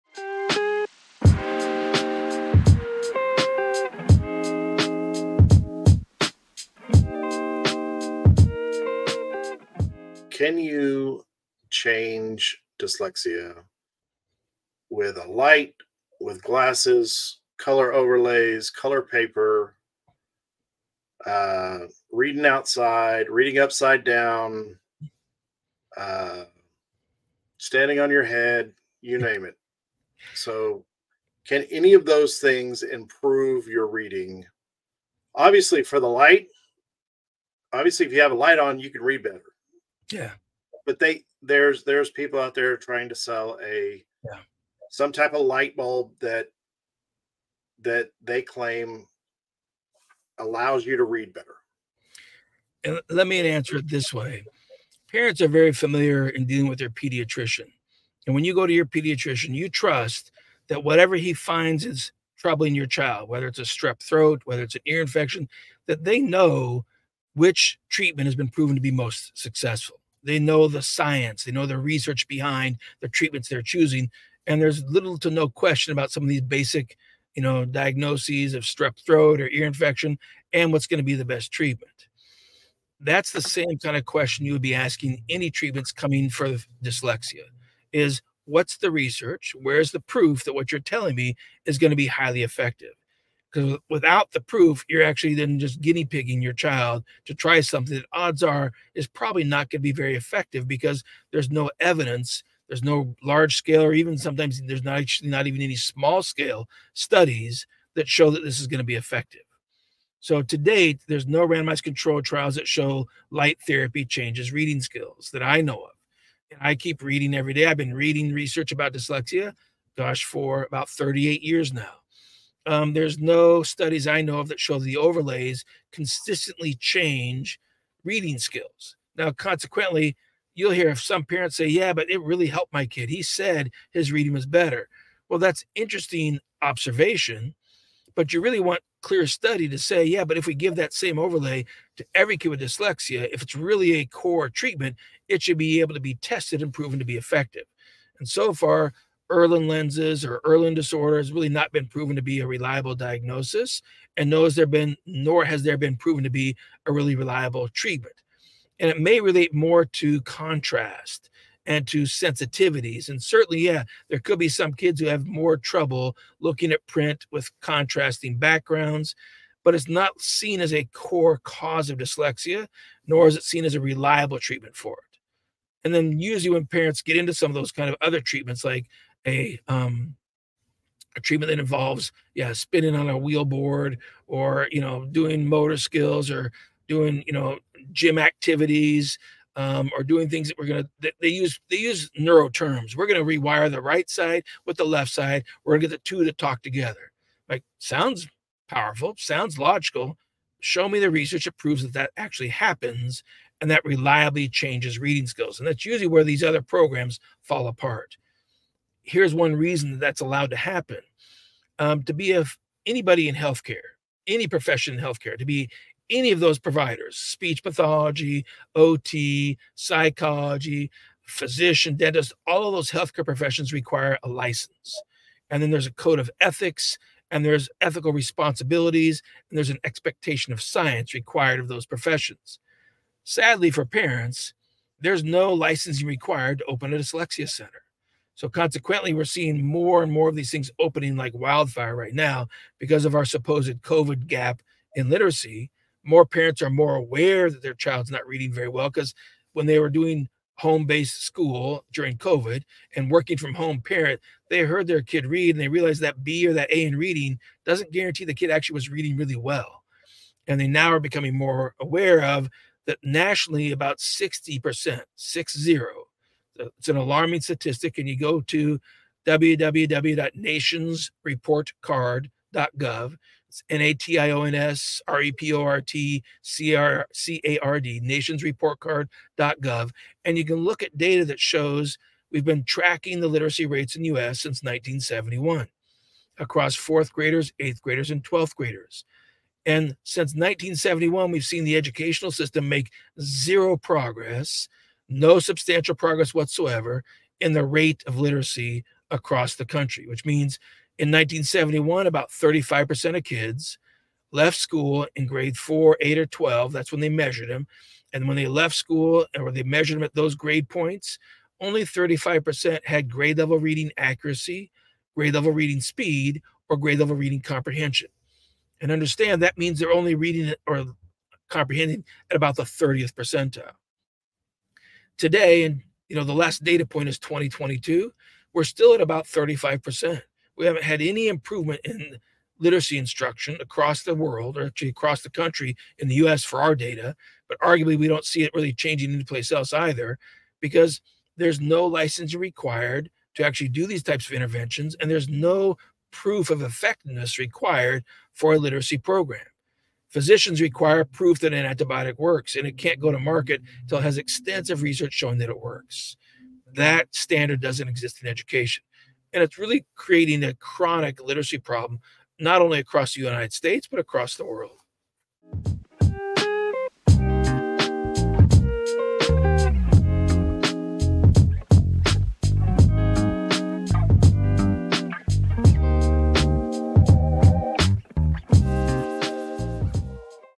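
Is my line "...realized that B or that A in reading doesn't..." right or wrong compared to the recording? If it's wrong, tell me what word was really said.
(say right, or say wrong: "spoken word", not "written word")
right.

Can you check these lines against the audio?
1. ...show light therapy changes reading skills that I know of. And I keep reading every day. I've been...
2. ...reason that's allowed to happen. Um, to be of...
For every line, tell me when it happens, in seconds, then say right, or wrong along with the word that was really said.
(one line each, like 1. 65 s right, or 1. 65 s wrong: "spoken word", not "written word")
1. 112 s right
2. 209 s right.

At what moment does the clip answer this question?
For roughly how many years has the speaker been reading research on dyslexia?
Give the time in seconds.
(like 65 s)
120 s.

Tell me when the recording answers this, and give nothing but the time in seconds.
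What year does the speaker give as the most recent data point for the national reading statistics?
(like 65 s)
327 s.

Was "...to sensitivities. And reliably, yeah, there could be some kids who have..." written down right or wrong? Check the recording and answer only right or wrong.
wrong.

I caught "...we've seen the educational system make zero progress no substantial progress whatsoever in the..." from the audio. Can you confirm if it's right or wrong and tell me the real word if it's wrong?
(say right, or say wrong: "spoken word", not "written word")
right.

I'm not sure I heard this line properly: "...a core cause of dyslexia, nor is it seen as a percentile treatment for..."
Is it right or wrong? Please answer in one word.
wrong.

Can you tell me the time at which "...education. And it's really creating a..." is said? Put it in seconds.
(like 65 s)
358 s.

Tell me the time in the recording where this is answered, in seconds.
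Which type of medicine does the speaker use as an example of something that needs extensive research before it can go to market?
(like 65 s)
351 s.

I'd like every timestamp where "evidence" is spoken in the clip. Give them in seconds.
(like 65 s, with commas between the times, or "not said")
101 s.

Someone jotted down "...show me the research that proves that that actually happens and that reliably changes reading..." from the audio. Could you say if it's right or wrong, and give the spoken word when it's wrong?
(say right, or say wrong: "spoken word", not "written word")
right.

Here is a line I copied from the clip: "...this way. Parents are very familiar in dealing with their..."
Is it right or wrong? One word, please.
right.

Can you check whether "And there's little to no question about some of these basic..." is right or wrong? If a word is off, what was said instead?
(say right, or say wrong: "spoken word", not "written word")
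right.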